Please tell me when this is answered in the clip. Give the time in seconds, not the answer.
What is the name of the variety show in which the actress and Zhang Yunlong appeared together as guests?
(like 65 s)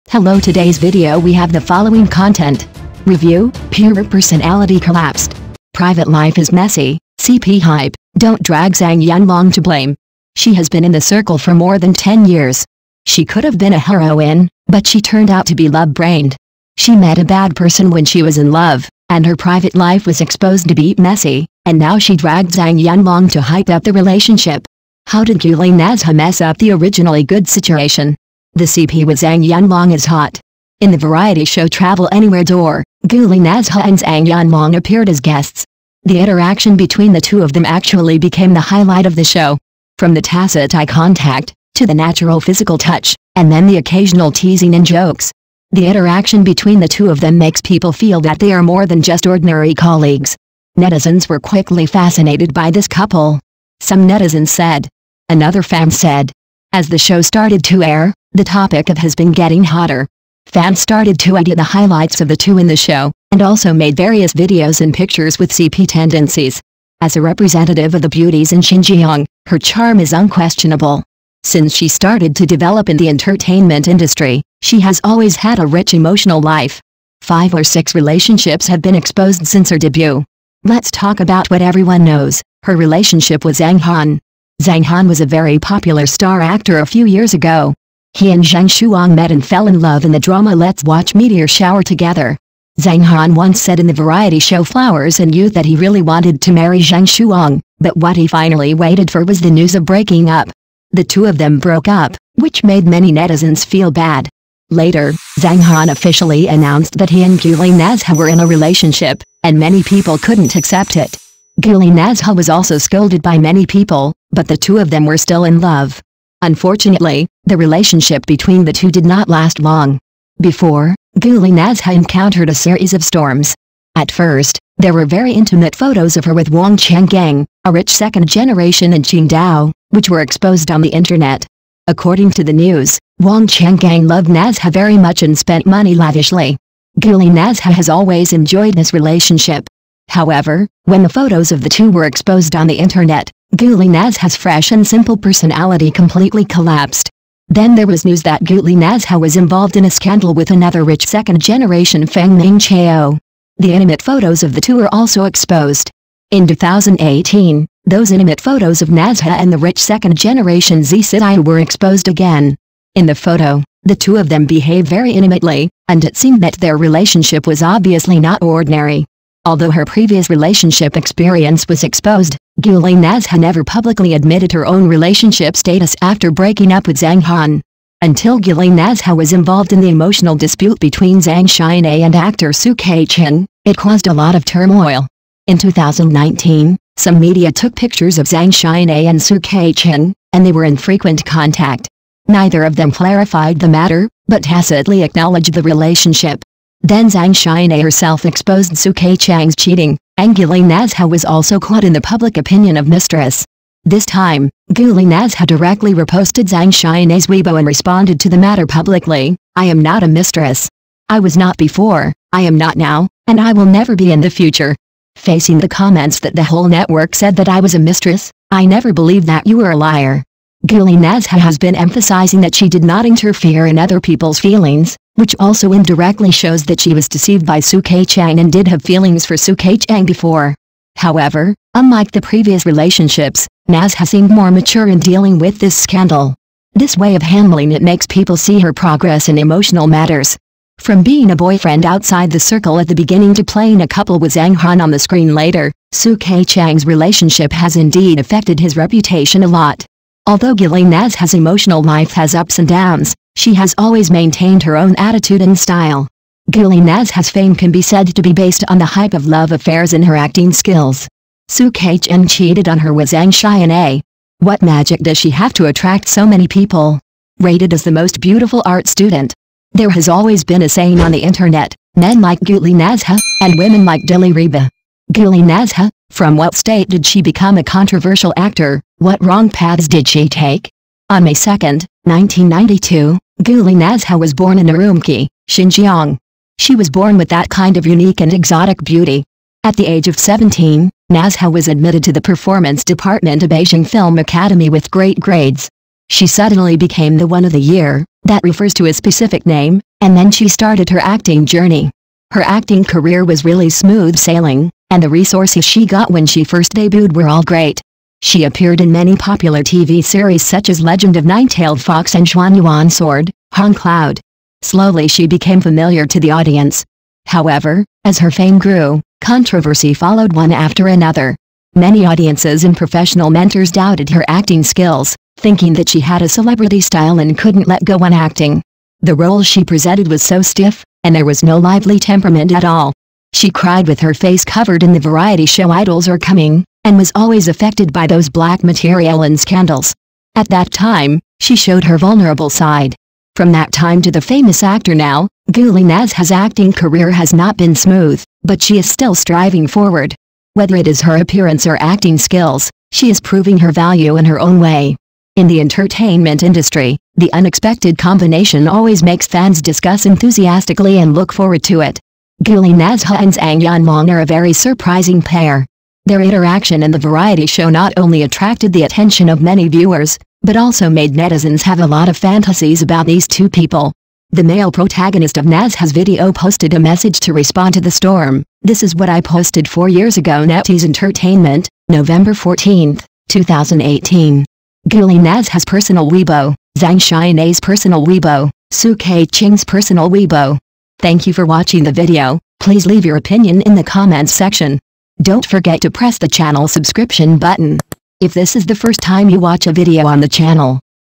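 31 s.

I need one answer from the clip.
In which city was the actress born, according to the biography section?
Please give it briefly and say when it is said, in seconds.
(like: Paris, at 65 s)
Urumqi, at 284 s.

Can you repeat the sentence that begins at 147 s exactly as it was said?
Then there was news that Guli Nazha was involved in a scandal with another rich second-generation Fang Ning Chao.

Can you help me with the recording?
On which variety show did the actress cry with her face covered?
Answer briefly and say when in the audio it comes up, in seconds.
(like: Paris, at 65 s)
Idols Are Coming, at 335 s.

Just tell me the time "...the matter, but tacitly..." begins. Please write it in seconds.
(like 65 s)
193 s.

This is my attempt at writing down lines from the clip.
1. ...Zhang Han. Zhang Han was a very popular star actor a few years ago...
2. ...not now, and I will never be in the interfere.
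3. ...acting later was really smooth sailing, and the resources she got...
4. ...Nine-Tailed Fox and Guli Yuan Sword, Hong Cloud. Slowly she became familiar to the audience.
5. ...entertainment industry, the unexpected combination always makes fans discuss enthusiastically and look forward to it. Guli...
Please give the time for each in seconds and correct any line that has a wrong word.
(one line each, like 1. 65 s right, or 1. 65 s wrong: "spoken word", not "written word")
1. 83 s right
2. 212 s wrong: "future", not "interfere"
3. 302 s wrong: "career", not "later"
4. 311 s wrong: "Xuan", not "Guli"
5. 355 s right.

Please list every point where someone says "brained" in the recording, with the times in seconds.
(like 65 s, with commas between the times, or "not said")
15 s.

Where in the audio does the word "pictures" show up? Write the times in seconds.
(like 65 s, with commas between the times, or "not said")
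64 s, 187 s.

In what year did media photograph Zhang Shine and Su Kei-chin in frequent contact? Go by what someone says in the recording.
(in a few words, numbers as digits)
2019.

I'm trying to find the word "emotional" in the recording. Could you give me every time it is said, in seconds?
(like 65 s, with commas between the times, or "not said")
75 s, 179 s, 239 s, 251 s.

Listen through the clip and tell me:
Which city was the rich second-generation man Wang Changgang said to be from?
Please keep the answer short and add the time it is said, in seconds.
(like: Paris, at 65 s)
Qingdao, at 129 s.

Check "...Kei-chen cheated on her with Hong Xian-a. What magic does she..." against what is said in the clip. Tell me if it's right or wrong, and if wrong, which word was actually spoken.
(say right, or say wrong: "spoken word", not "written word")
wrong: "Zhang", not "Hong".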